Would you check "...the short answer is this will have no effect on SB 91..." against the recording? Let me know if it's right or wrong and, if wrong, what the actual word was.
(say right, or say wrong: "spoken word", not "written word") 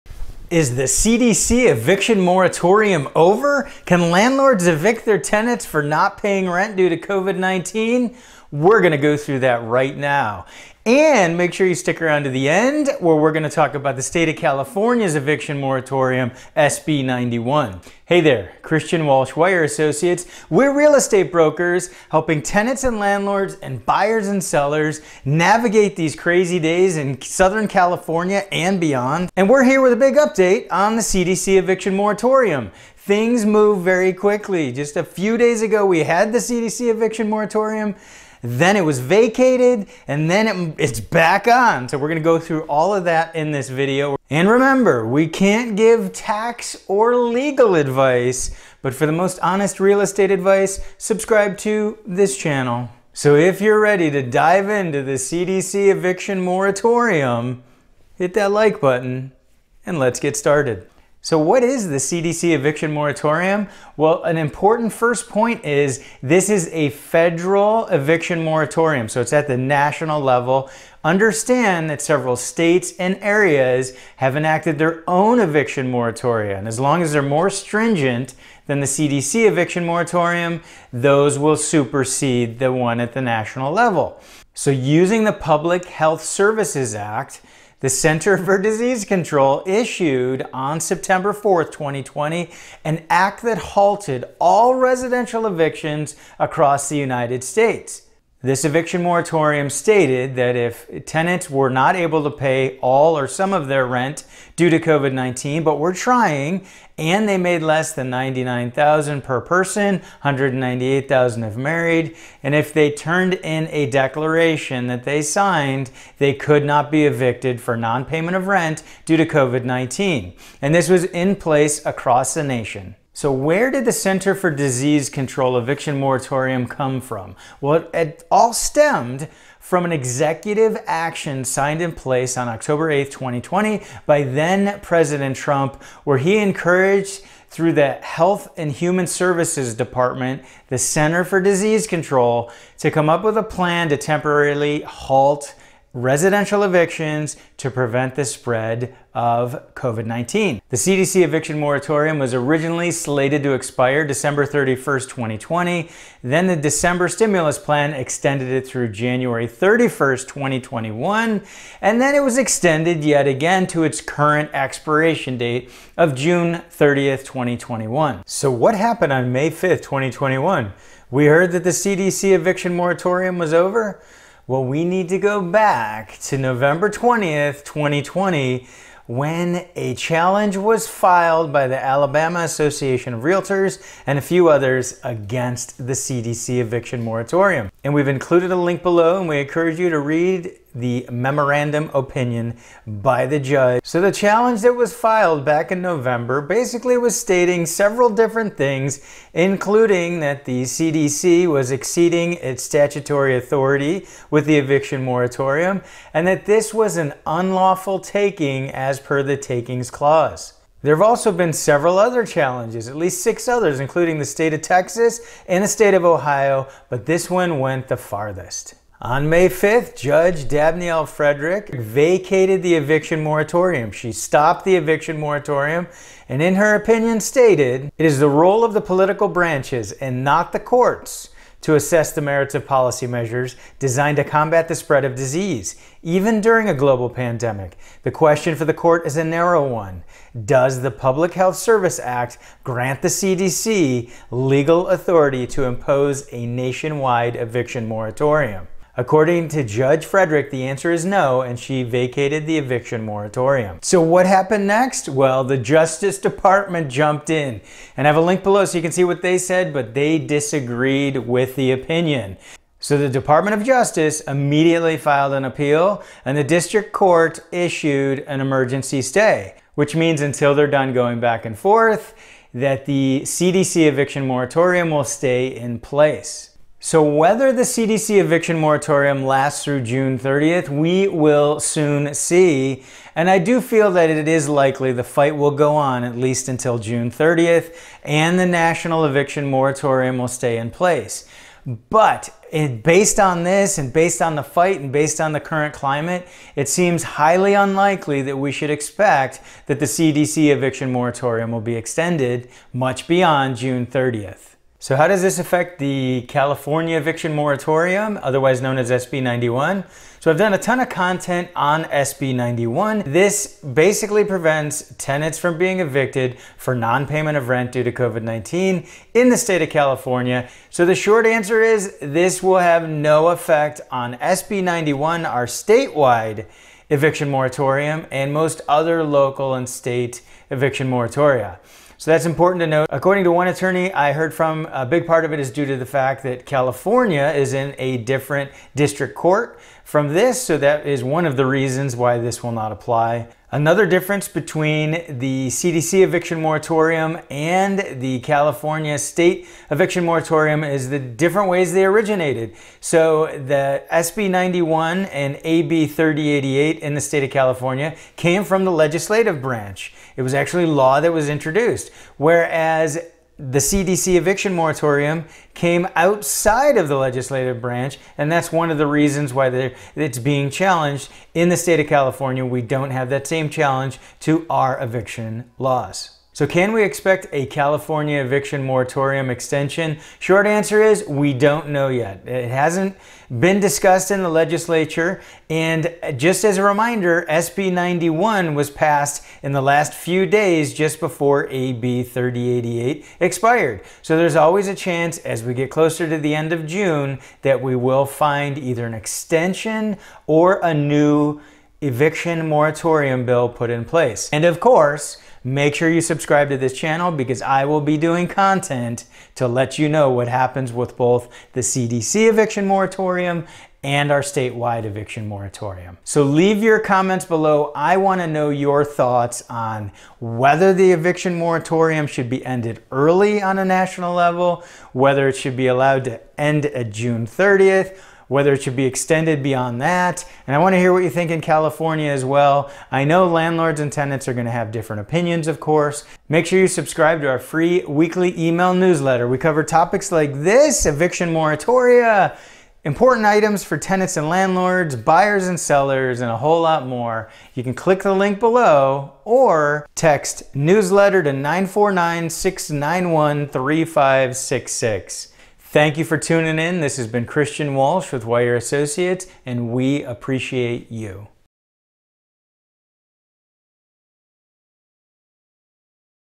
right.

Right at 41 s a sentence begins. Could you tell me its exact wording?
So we're gonna go through all of that in this video.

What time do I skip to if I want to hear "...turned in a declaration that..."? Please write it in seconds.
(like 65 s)
112 s.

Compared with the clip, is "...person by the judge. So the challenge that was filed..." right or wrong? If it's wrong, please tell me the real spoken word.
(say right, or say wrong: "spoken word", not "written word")
wrong: "opinion", not "person".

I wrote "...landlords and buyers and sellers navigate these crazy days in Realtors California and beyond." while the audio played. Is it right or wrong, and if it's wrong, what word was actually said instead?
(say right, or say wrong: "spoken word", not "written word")
wrong: "Southern", not "Realtors".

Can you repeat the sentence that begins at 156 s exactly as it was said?
Then the December stimulus plan extended it through January 31st, 2021.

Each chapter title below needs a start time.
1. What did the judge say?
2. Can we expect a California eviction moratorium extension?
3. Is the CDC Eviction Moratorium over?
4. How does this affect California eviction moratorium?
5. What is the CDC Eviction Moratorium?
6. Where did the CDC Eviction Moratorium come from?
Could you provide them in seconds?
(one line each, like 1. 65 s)
1. 228 s
2. 376 s
3. 168 s
4. 305 s
5. 61 s
6. 123 s.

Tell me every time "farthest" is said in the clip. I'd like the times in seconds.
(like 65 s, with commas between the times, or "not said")
217 s.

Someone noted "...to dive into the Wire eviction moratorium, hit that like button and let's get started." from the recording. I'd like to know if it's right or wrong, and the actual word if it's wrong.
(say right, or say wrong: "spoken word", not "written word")
wrong: "CDC", not "Wire".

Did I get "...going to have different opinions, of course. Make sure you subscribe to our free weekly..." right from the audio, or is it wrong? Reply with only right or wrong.
right.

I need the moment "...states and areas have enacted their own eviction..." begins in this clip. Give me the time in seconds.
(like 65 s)
72 s.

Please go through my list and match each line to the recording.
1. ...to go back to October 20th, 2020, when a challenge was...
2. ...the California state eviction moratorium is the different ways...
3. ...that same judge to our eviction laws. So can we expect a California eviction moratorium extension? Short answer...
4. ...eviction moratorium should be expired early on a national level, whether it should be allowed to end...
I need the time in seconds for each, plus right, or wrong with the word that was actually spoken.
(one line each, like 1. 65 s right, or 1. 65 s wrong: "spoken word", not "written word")
1. 175 s wrong: "November", not "October"
2. 348 s right
3. 373 s wrong: "challenge", not "judge"
4. 420 s wrong: "ended", not "expired".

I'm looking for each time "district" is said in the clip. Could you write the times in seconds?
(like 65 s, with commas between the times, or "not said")
266 s, 338 s.